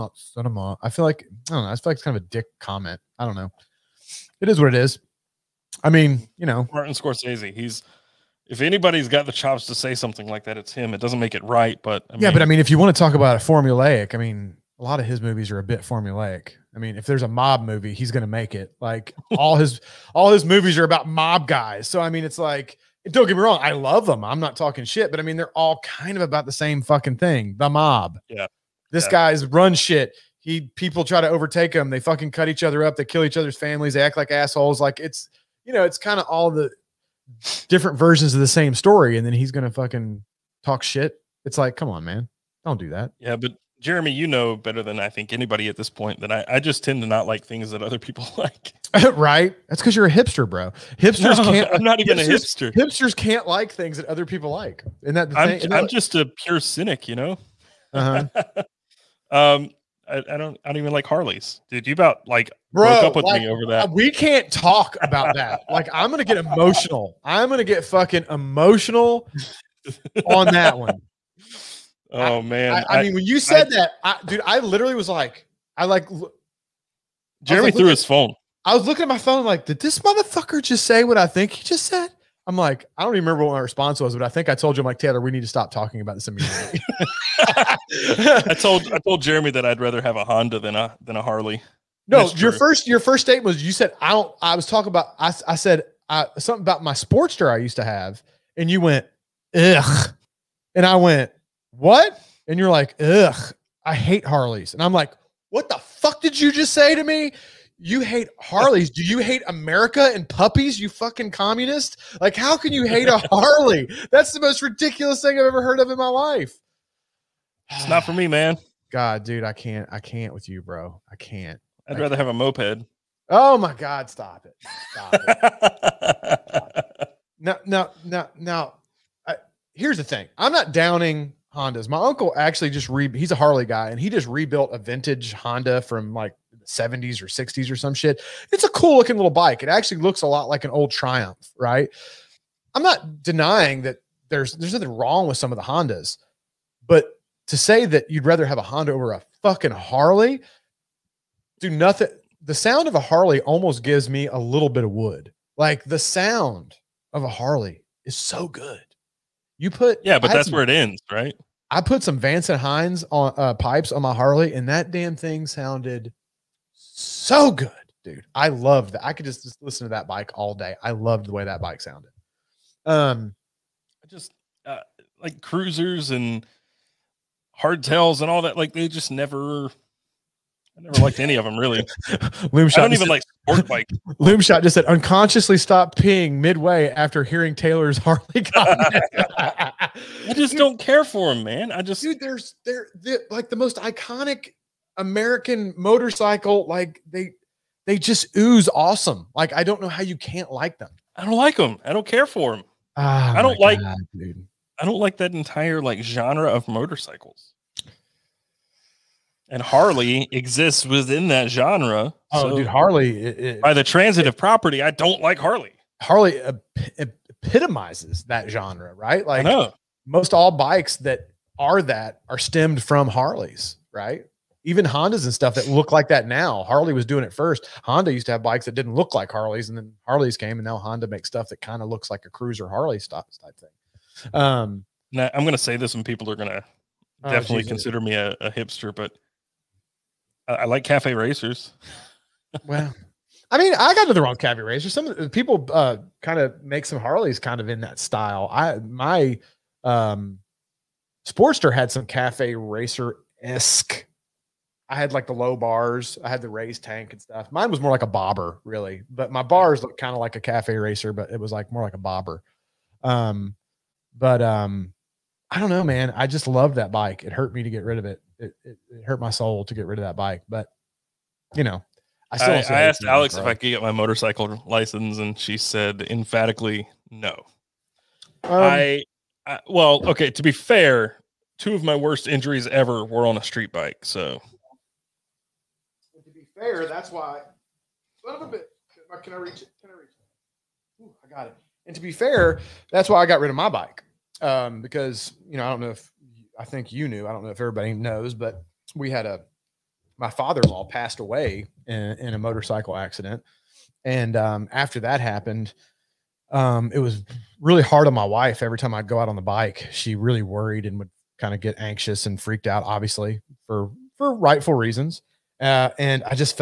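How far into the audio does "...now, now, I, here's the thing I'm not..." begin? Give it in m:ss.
2:08.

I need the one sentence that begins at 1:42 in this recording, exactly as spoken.
And you're like ugh, I hate Harleys, and I'm like, what the fuck did you just say to me?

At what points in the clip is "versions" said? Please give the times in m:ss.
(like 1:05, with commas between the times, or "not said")
0:37.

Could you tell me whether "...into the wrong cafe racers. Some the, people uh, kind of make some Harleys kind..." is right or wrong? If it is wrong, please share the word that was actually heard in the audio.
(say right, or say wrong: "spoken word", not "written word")
right.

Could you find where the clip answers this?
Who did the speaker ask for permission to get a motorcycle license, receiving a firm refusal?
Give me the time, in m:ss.
4:33.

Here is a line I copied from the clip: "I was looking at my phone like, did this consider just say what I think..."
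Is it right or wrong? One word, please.
wrong.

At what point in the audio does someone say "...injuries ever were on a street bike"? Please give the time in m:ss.
4:42.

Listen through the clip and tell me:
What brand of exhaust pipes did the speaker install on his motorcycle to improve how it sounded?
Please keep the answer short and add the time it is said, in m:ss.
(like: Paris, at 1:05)
Vance and Hines, at 2:42.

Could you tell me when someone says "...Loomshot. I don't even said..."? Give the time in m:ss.
3:02.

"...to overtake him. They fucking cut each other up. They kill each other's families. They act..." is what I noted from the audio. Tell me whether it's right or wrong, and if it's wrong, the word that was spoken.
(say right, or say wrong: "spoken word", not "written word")
right.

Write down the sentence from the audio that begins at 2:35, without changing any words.
Like the sound of a Harley is so good.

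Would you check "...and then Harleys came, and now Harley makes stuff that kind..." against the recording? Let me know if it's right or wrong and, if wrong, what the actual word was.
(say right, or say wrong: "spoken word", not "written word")
wrong: "Honda", not "Harley".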